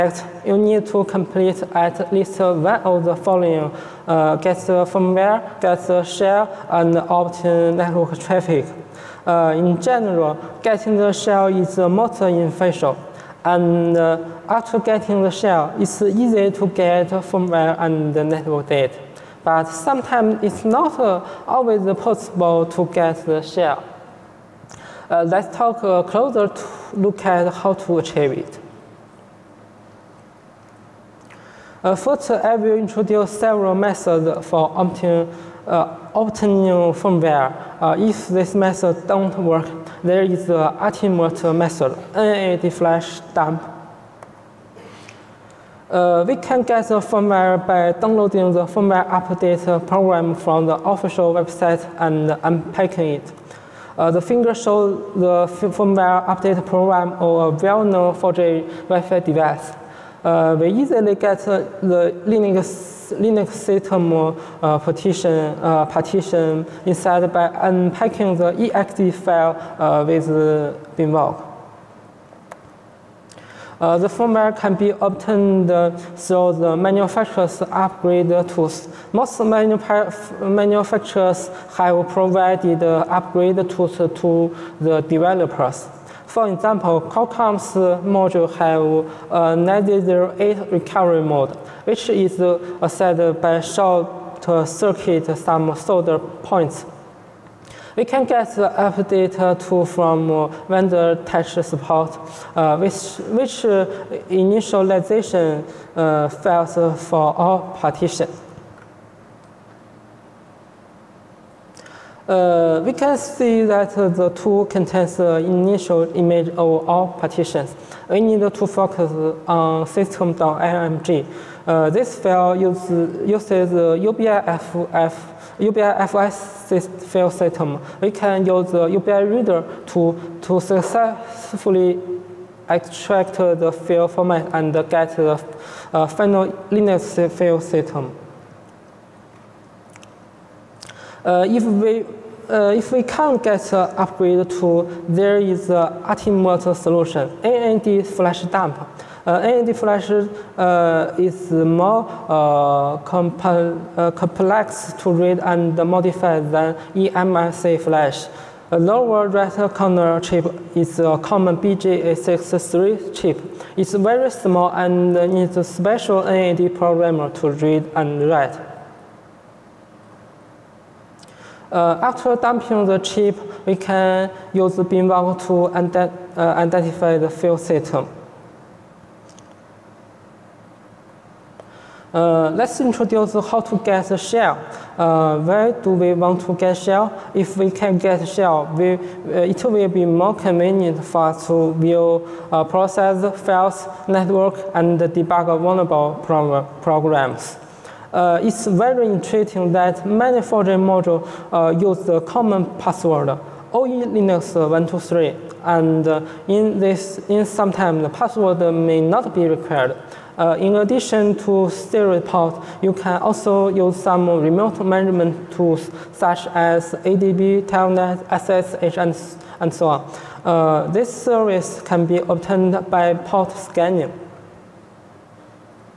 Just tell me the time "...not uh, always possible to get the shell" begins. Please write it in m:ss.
0:20.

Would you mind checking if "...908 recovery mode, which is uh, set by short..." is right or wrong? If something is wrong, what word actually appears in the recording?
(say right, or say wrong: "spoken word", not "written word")
right.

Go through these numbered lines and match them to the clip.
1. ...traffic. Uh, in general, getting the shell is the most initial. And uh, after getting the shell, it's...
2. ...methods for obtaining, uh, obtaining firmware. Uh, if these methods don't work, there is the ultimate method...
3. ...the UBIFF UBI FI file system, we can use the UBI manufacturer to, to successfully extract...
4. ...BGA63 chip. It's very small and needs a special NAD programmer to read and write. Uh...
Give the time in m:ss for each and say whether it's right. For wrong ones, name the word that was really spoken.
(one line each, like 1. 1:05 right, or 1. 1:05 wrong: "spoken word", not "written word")
1. 0:08 wrong: "essential", not "initial"
2. 0:33 right
3. 2:03 wrong: "reader", not "manufacturer"
4. 2:41 right.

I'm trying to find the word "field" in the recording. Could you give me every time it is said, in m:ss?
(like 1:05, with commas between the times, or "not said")
2:57.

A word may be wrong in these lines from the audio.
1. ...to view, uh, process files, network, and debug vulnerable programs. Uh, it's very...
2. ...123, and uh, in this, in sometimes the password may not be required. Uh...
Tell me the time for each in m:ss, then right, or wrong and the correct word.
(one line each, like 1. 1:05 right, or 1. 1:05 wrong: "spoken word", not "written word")
1. 3:11 right
2. 3:24 right.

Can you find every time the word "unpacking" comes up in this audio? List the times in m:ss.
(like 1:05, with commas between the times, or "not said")
0:52, 1:07.